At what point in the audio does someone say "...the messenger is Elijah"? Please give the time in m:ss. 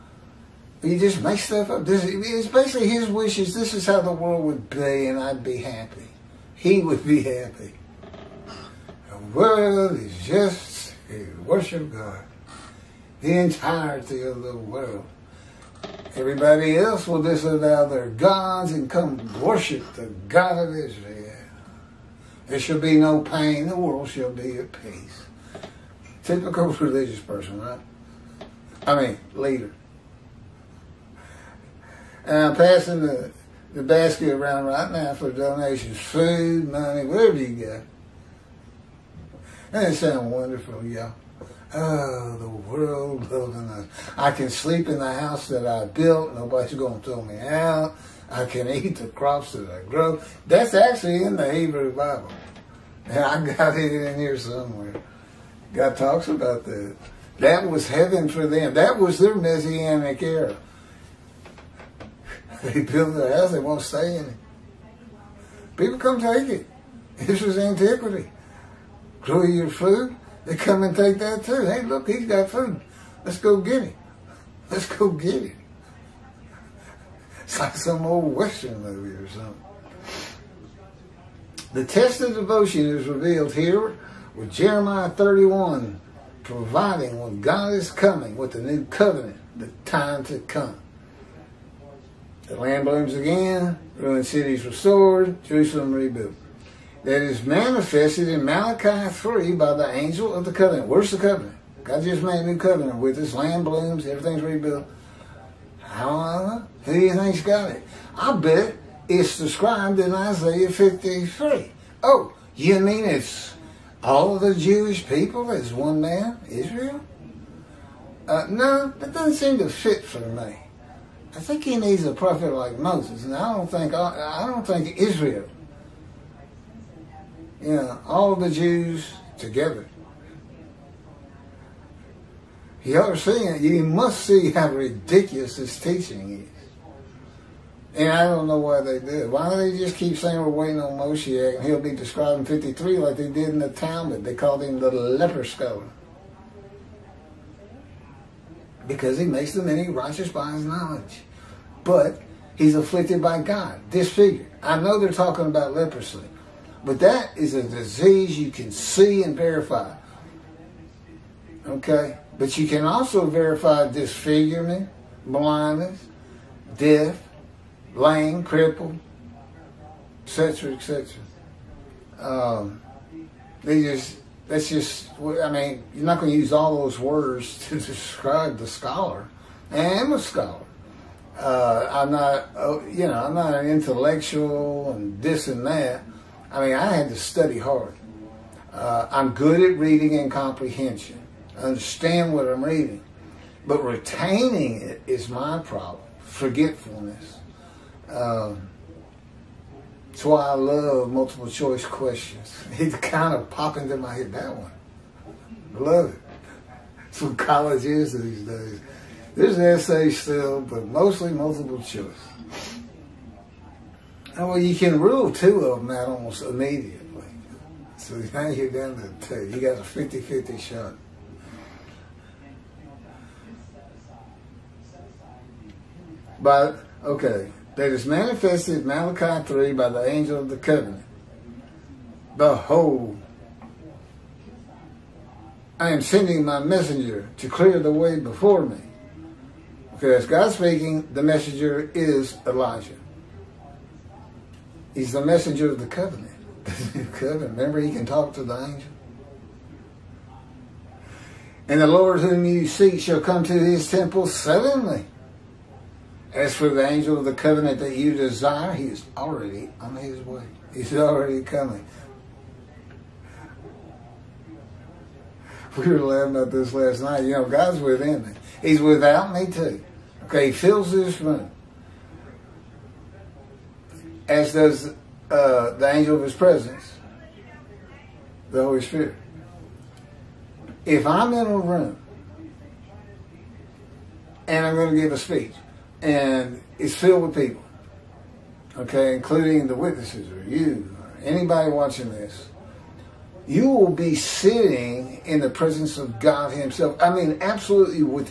4:01.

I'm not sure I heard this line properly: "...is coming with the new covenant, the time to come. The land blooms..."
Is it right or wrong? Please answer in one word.
right.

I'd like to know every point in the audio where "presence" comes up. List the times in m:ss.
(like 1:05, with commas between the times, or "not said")
4:36, 4:55.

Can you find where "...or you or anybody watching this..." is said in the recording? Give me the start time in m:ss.
4:50.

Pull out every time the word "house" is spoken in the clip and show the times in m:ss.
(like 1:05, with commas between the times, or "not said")
0:45, 1:03.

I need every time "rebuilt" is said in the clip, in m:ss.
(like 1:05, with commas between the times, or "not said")
1:35, 1:44.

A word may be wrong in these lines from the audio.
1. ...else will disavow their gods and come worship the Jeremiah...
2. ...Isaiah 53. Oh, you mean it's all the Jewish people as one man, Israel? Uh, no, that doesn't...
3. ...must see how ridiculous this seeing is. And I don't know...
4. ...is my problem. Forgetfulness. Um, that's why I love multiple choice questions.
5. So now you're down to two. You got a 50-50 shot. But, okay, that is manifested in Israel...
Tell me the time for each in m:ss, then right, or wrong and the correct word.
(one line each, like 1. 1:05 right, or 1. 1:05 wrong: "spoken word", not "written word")
1. 0:16 wrong: "God", not "Jeremiah"
2. 1:50 right
3. 2:13 wrong: "teaching", not "seeing"
4. 3:15 right
5. 3:37 wrong: "Malachi", not "Israel".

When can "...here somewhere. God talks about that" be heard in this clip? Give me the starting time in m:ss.
0:54.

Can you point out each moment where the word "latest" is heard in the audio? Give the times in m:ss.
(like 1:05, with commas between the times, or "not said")
not said.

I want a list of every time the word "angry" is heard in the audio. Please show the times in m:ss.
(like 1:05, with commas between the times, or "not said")
not said.